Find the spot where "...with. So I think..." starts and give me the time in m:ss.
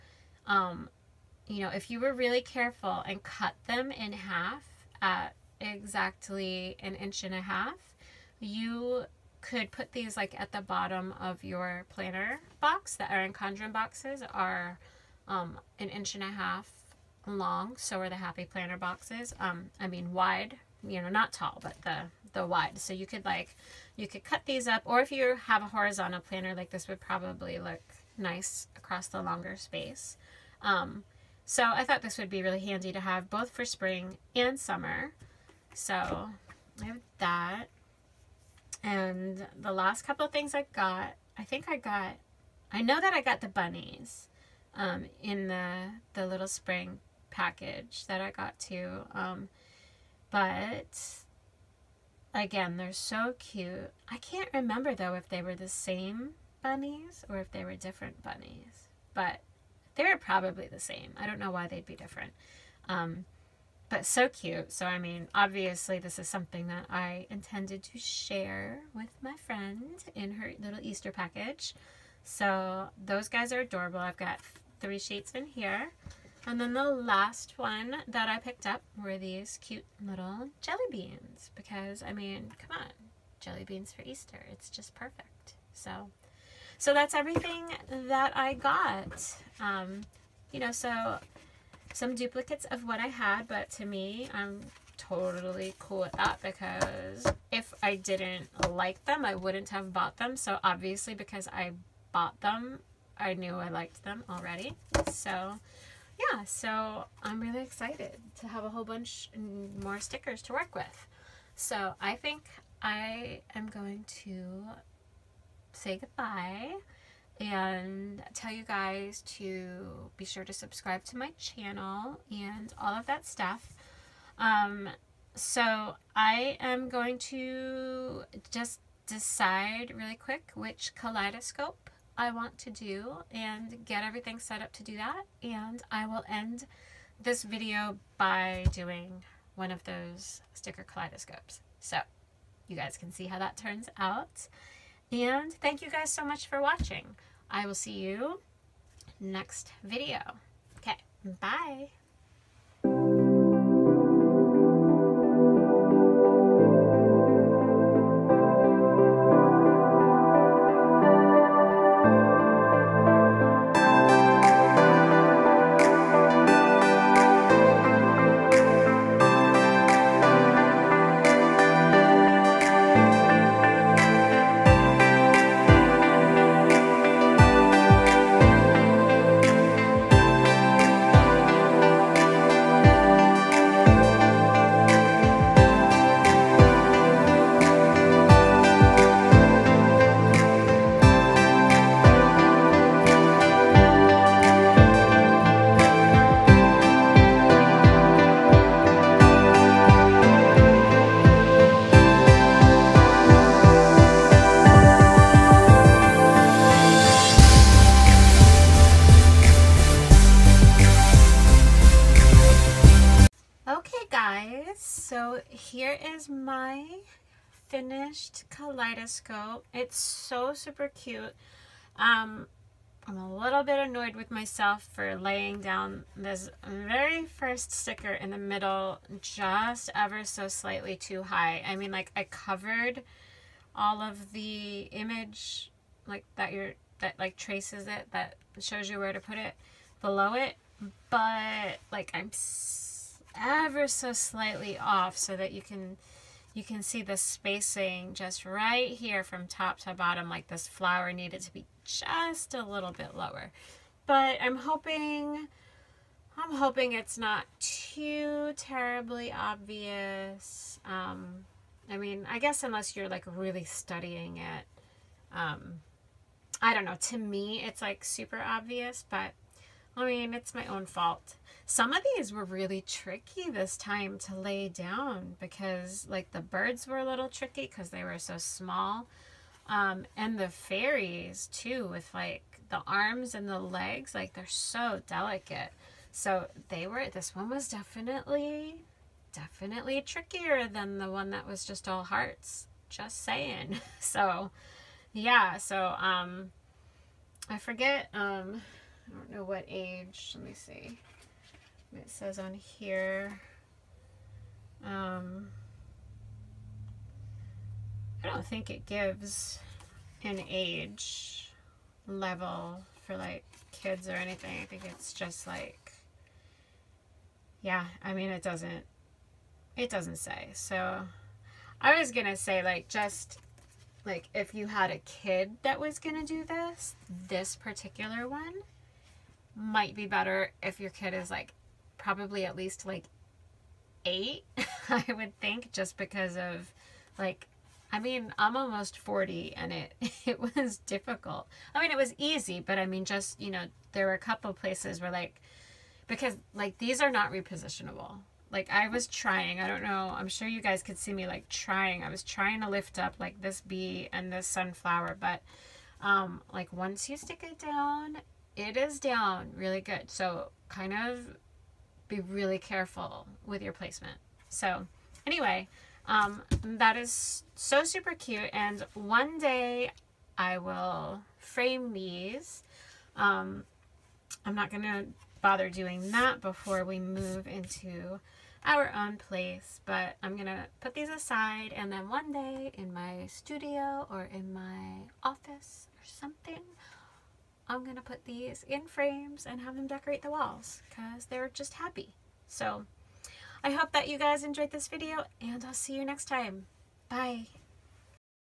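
1:50.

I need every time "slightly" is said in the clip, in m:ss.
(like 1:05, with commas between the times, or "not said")
3:50, 4:04.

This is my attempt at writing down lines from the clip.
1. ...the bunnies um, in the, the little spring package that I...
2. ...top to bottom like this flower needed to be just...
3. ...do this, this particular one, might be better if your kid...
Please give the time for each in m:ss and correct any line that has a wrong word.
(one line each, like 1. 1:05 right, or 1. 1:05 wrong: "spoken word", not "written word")
1. 0:43 right
2. 4:09 right
3. 5:26 right.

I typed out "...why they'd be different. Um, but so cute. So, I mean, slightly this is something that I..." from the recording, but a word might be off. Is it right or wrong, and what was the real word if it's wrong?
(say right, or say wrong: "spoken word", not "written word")
wrong: "obviously", not "slightly".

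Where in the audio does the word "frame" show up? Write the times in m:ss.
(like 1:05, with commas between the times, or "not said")
6:11, 6:28.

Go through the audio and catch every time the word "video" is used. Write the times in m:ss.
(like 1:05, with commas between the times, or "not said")
2:17, 2:29, 6:34.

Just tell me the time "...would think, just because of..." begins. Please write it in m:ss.
5:35.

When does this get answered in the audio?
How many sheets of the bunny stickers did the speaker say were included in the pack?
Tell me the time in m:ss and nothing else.
1:14.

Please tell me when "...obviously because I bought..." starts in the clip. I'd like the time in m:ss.
1:40.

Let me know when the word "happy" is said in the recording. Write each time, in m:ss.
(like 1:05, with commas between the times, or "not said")
0:18, 6:31.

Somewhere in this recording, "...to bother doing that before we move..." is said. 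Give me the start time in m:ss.
6:14.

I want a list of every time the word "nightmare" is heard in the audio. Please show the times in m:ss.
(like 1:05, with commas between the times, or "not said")
not said.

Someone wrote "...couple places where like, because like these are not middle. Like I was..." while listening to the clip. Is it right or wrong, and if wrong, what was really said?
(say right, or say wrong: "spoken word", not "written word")
wrong: "repositionable", not "middle".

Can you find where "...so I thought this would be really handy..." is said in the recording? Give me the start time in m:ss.
0:31.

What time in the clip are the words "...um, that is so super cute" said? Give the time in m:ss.
6:06.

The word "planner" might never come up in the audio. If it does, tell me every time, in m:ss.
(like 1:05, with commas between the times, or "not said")
0:11, 0:18, 0:26.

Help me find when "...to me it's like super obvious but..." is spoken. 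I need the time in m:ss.
4:27.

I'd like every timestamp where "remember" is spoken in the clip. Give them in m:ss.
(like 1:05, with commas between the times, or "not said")
0:54.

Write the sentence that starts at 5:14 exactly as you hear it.
I think it's just like, yeah, I mean, it doesn't, it doesn't say.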